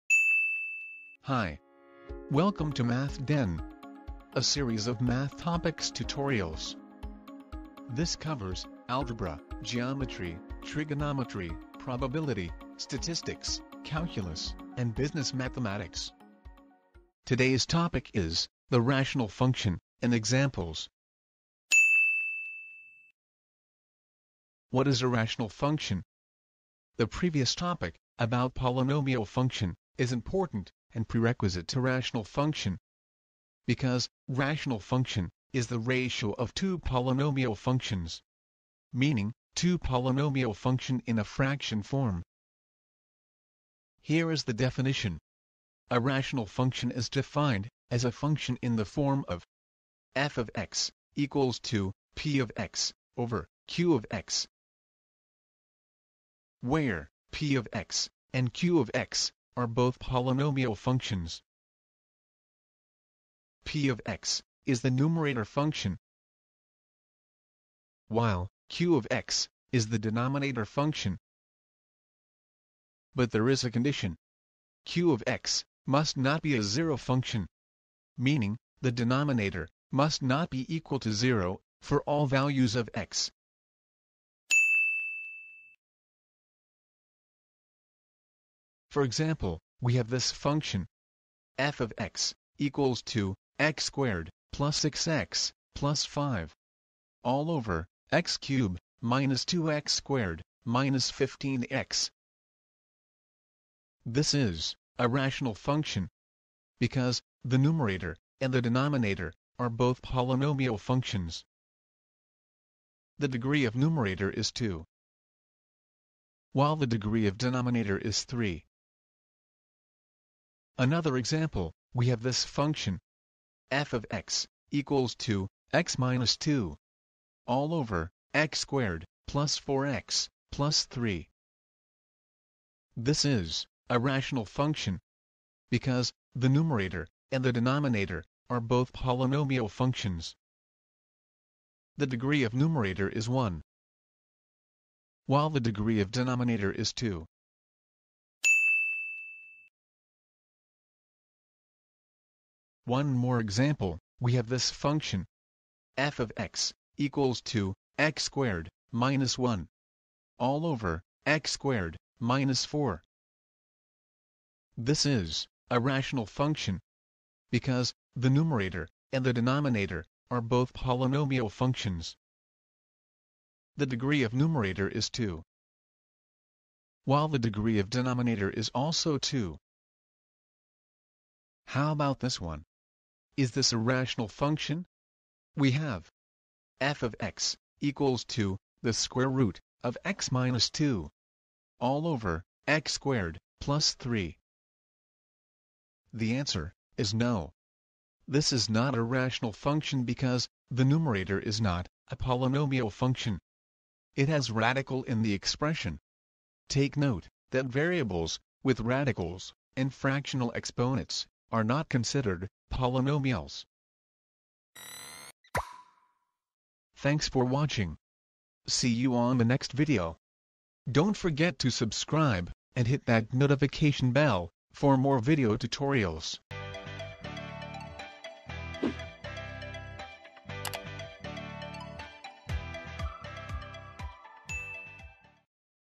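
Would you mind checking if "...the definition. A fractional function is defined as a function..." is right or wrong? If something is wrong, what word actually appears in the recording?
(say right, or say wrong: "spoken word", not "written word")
wrong: "rational", not "fractional".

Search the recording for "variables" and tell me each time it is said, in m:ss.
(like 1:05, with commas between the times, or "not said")
3:27.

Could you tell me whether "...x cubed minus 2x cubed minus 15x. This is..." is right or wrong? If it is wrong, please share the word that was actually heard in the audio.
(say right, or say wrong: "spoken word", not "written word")
wrong: "squared", not "cubed".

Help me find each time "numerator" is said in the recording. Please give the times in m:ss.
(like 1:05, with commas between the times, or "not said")
1:04, 1:47, 1:53, 2:16, 2:22, 2:48, 2:54, 3:20.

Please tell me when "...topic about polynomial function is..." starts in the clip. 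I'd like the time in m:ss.
0:27.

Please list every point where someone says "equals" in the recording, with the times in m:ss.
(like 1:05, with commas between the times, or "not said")
0:51, 1:20, 1:32, 2:04, 2:36, 3:07.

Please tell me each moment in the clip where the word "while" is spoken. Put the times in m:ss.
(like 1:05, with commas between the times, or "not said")
1:08, 1:56, 2:25, 2:57.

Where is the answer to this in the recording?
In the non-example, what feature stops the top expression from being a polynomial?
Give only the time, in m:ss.
3:24.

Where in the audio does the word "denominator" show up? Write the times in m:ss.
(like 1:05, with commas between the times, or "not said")
1:09, 1:18, 1:48, 1:57, 2:17, 2:26, 2:49, 2:57.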